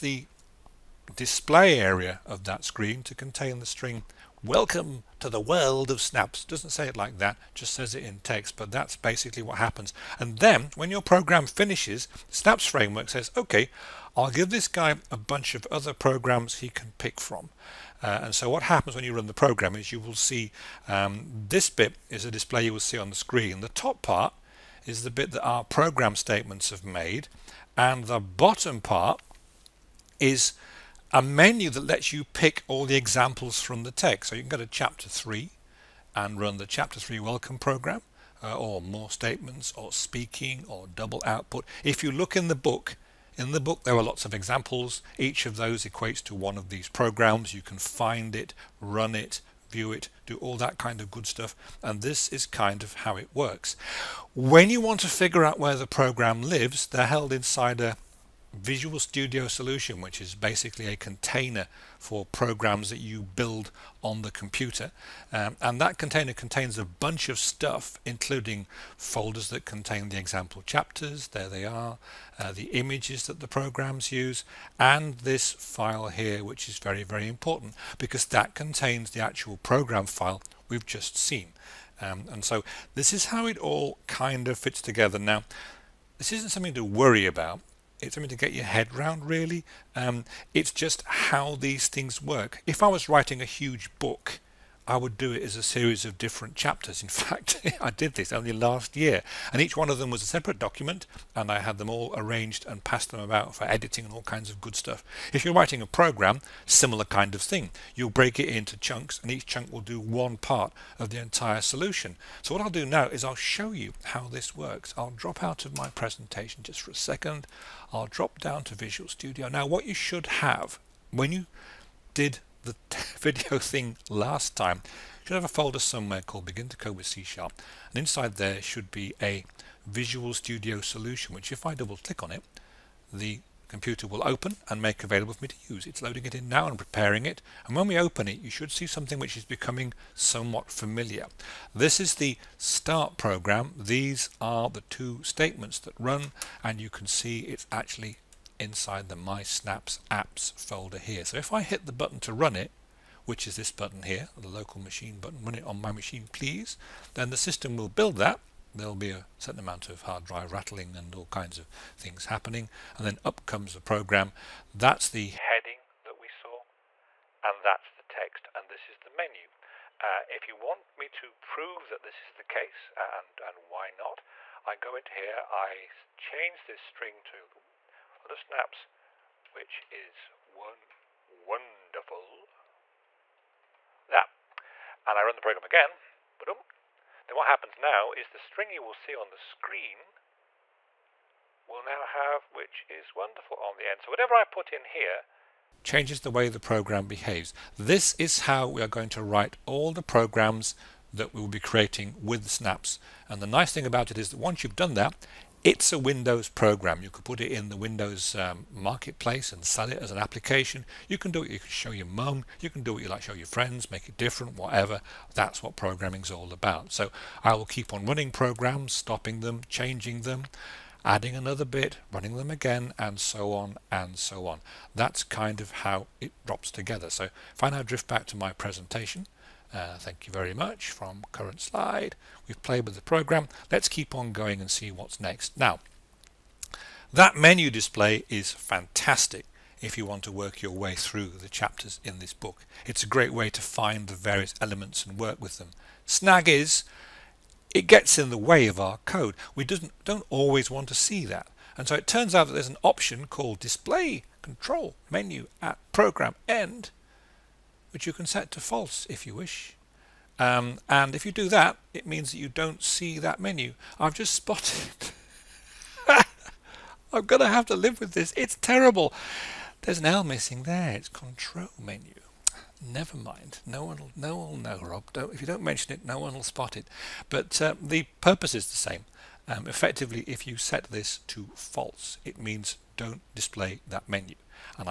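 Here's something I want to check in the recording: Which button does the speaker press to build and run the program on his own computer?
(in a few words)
local machine button.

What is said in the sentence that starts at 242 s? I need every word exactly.
It's a great way to find the various elements and work with them.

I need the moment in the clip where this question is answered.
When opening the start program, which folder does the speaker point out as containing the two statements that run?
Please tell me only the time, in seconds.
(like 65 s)
149 s.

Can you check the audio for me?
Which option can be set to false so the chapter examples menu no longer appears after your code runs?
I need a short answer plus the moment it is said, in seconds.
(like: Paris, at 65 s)
display control menu at program end, at 253 s.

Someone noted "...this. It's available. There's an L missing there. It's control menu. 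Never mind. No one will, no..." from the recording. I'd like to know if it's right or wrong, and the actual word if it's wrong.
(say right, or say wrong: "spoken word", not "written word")
wrong: "terrible", not "available".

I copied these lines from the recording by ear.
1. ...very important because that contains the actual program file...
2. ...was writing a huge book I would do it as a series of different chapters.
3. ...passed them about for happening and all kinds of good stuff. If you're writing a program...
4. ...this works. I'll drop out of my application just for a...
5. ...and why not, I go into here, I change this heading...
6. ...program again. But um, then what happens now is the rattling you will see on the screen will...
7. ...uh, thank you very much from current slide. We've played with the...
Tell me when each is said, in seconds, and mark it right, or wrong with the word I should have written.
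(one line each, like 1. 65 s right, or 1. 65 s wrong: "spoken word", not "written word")
1. 77 s right
2. 92 s right
3. 102 s wrong: "editing", not "happening"
4. 114 s wrong: "presentation", not "application"
5. 173 s wrong: "string", not "heading"
6. 185 s wrong: "string", not "rattling"
7. 229 s right.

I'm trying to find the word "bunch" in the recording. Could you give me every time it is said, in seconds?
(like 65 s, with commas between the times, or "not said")
15 s, 66 s.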